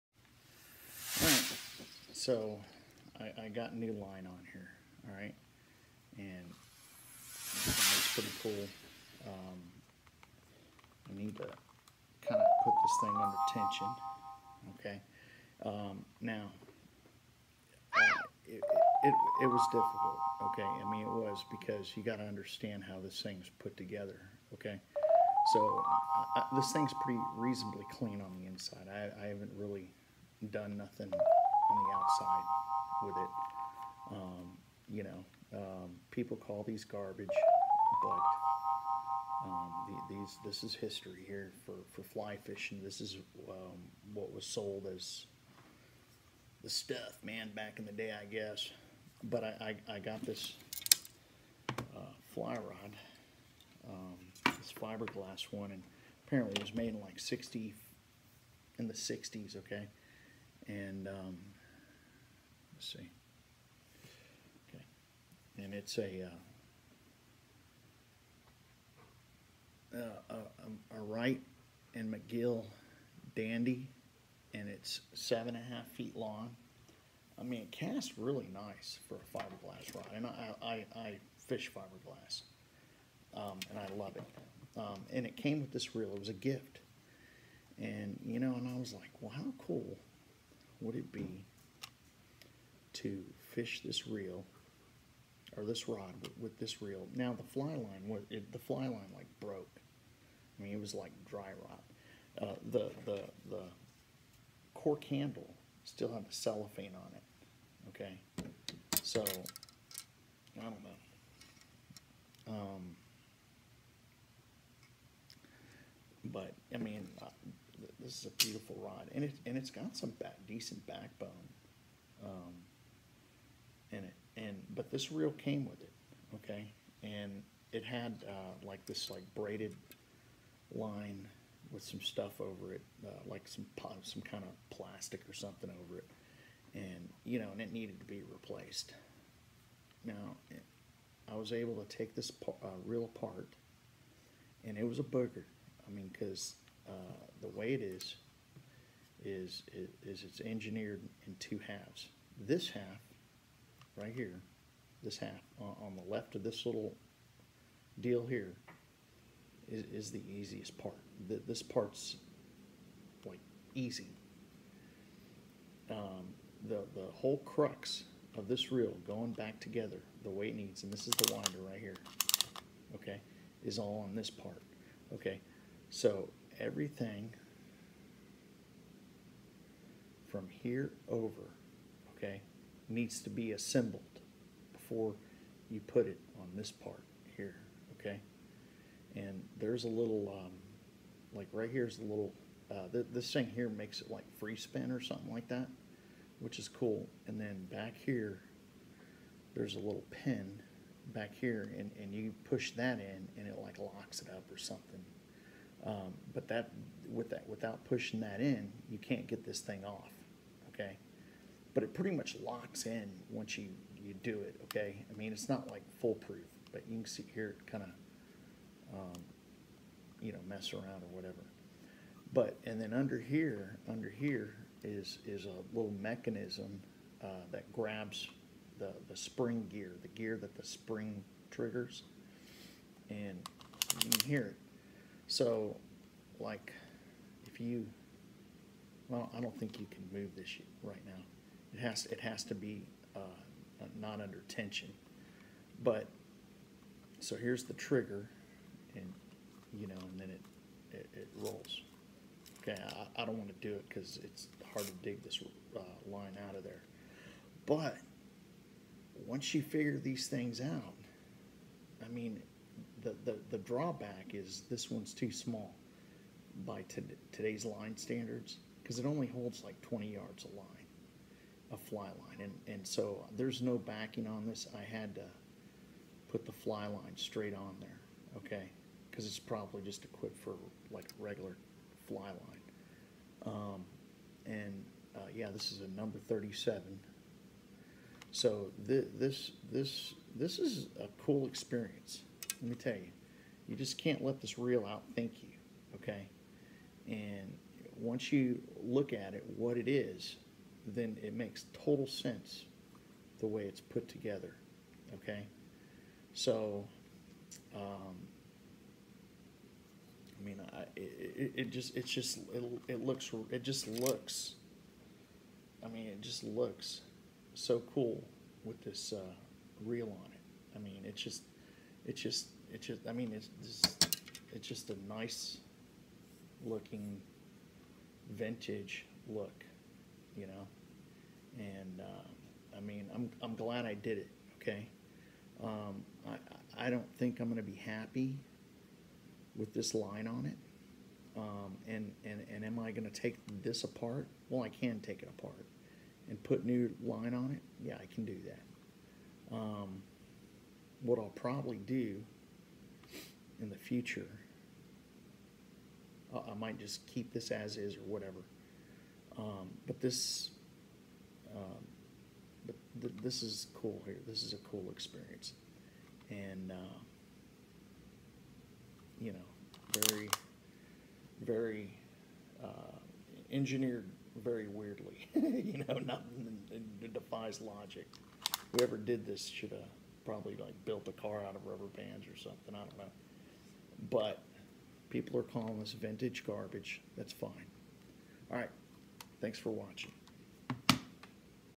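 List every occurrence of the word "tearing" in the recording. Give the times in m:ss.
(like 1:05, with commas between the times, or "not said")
not said.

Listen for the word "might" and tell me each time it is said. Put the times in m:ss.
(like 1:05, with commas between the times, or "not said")
5:56.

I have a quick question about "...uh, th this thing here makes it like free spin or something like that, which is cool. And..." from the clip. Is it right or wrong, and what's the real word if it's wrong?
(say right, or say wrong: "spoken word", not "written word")
right.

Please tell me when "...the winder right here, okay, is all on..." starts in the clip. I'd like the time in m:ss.
2:51.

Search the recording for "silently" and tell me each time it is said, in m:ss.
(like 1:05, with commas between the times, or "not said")
not said.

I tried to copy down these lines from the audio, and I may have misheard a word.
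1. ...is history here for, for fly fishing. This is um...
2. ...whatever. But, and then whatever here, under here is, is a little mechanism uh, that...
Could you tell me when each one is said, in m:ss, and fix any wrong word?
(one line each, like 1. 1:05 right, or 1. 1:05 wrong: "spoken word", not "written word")
1. 0:40 right
2. 3:41 wrong: "under", not "whatever".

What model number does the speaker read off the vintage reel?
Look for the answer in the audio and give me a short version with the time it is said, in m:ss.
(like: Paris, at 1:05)
37, at 4:45.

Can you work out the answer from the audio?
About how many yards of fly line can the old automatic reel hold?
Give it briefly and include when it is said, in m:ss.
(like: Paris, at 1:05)
20 yards, at 4:29.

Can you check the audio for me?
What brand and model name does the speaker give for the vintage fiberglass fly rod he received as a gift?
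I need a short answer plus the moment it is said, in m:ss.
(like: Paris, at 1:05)
Wright and McGill Dandy, at 1:11.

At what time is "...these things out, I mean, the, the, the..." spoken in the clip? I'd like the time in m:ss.
4:19.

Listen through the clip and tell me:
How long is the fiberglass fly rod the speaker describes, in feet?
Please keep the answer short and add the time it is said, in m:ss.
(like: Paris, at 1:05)
7.5 feet, at 1:15.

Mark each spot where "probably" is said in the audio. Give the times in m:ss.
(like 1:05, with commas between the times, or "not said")
4:39, 5:51, 6:20.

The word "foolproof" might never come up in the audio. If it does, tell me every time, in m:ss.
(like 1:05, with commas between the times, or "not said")
3:36.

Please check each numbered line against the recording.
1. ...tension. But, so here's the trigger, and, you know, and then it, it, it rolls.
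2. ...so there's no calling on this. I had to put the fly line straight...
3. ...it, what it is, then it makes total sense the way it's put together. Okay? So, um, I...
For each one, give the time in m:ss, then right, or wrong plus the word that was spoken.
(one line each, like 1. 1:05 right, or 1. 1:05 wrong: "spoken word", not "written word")
1. 4:04 right
2. 4:32 wrong: "backing", not "calling"
3. 4:59 right.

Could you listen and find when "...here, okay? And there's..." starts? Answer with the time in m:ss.
3:07.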